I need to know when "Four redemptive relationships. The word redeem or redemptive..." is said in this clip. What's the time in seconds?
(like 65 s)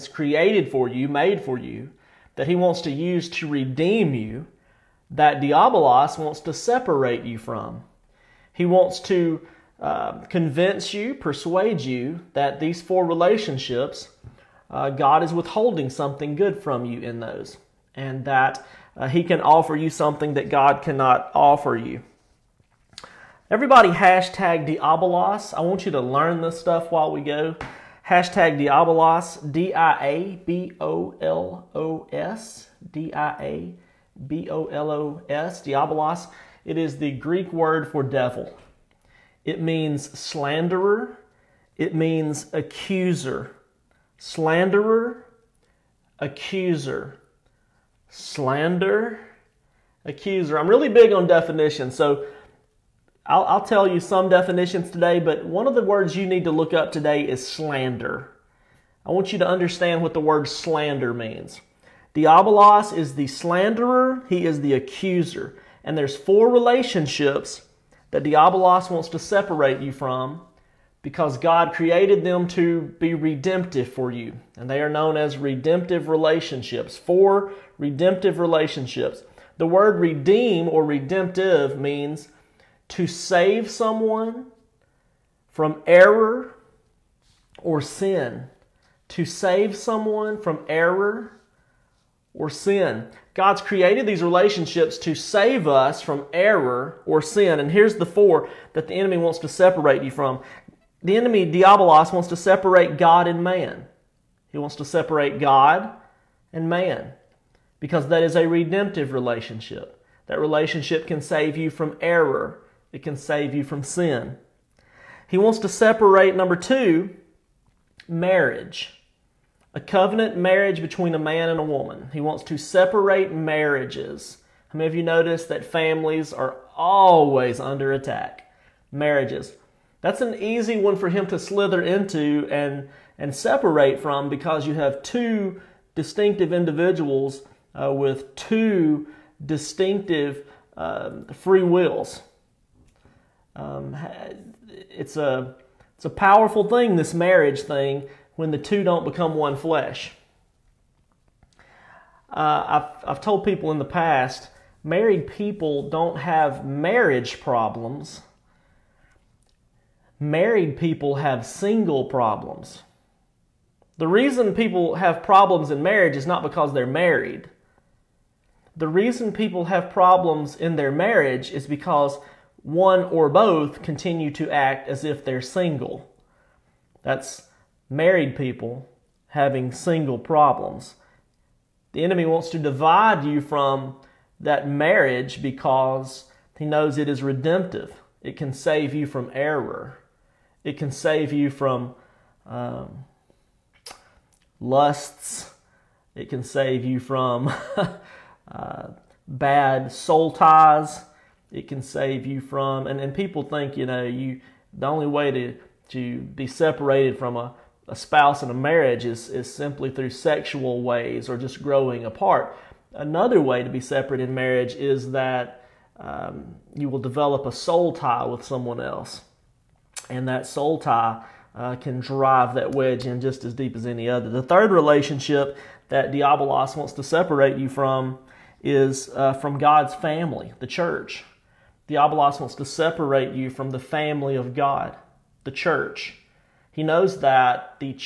76 s.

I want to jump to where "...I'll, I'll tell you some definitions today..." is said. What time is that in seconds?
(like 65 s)
53 s.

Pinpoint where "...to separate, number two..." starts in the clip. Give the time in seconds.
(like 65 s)
115 s.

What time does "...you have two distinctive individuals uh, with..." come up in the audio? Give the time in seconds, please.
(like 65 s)
134 s.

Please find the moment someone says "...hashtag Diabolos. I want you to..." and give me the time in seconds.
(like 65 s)
23 s.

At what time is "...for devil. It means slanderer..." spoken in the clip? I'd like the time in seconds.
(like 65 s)
37 s.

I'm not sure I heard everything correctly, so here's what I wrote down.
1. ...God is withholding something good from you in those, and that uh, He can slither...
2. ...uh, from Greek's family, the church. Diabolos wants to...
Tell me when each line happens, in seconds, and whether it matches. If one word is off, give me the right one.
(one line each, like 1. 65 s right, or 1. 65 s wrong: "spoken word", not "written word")
1. 14 s wrong: "offer", not "slither"
2. 229 s wrong: "God", not "Greek".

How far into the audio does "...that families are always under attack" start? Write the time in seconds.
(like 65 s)
125 s.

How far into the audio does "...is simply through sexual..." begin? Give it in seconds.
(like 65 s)
209 s.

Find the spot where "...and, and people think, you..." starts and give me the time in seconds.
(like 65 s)
202 s.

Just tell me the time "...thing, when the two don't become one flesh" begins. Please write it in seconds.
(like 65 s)
147 s.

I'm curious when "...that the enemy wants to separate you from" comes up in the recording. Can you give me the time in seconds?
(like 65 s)
98 s.